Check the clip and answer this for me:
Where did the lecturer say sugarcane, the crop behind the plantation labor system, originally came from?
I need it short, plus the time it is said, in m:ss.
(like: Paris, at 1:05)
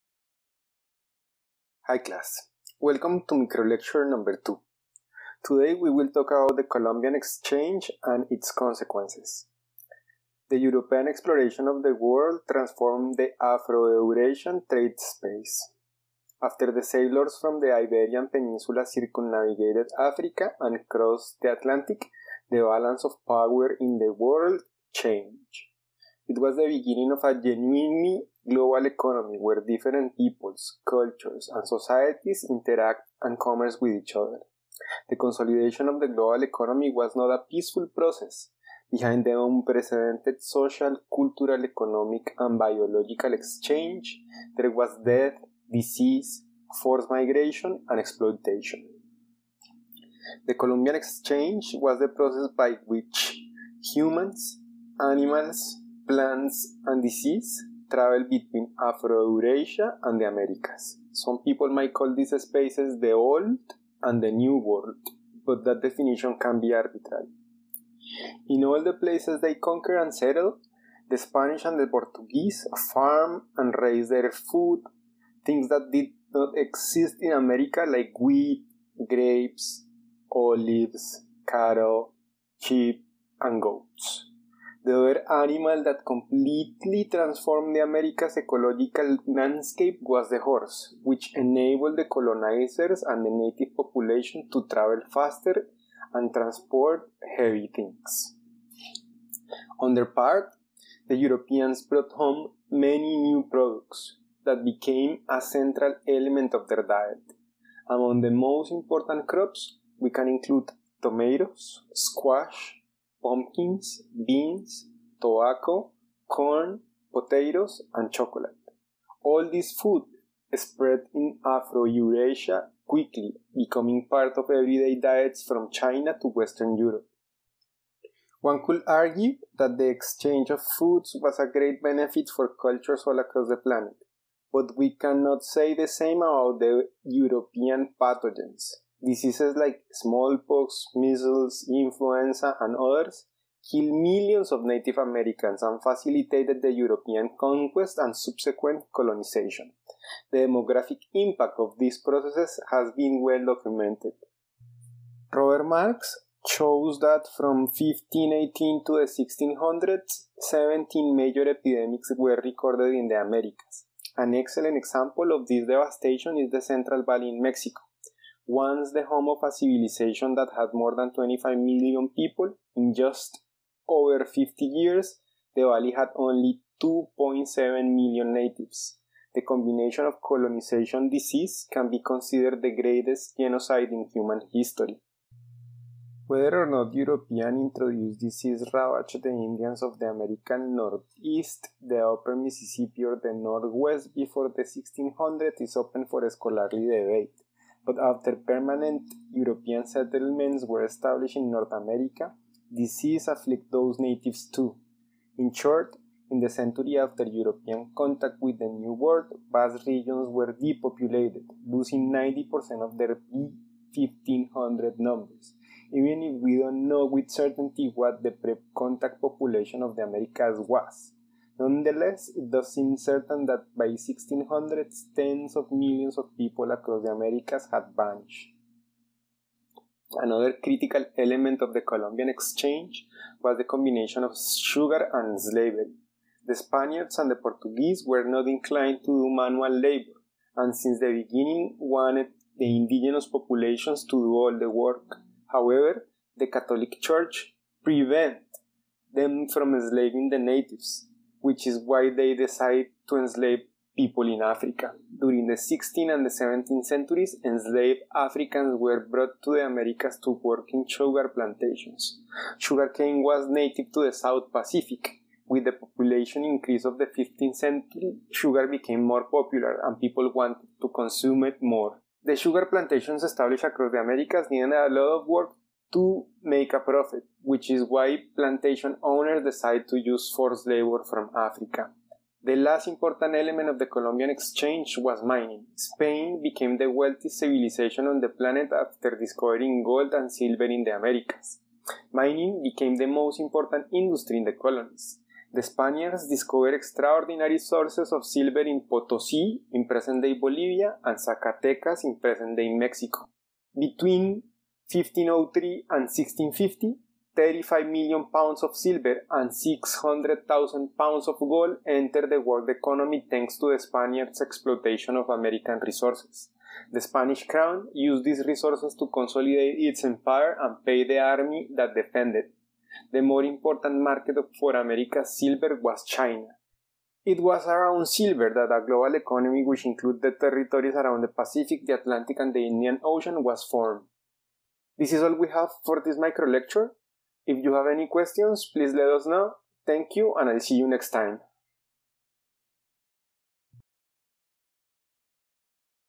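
the South Pacific, at 4:24.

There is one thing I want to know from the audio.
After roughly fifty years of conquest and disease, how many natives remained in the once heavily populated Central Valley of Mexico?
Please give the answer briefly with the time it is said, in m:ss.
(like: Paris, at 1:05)
2.7 million, at 2:56.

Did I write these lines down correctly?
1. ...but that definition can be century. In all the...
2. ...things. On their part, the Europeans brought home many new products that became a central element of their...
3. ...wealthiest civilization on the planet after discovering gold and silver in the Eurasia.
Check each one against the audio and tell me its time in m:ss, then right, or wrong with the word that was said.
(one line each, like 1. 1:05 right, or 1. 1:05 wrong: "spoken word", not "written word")
1. 1:05 wrong: "arbitrary", not "century"
2. 1:37 right
3. 4:46 wrong: "Americas", not "Eurasia".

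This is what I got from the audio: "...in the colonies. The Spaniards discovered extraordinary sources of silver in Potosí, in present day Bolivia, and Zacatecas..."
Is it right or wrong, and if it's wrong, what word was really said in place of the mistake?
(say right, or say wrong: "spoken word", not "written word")
right.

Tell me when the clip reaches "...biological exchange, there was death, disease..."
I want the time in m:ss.
0:42.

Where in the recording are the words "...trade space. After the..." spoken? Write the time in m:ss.
0:14.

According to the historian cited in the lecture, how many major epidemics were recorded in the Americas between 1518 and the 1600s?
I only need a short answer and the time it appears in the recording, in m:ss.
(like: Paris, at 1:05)
17, at 2:40.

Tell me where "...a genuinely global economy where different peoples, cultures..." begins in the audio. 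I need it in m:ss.
0:27.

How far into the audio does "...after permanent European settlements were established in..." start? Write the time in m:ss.
3:17.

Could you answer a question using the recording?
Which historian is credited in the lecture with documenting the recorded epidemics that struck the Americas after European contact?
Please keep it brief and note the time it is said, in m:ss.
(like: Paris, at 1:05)
Robert Marks, at 2:35.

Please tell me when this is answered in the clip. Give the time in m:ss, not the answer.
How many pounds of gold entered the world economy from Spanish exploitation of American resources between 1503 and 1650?
5:09.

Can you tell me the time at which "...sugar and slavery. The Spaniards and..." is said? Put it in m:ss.
3:54.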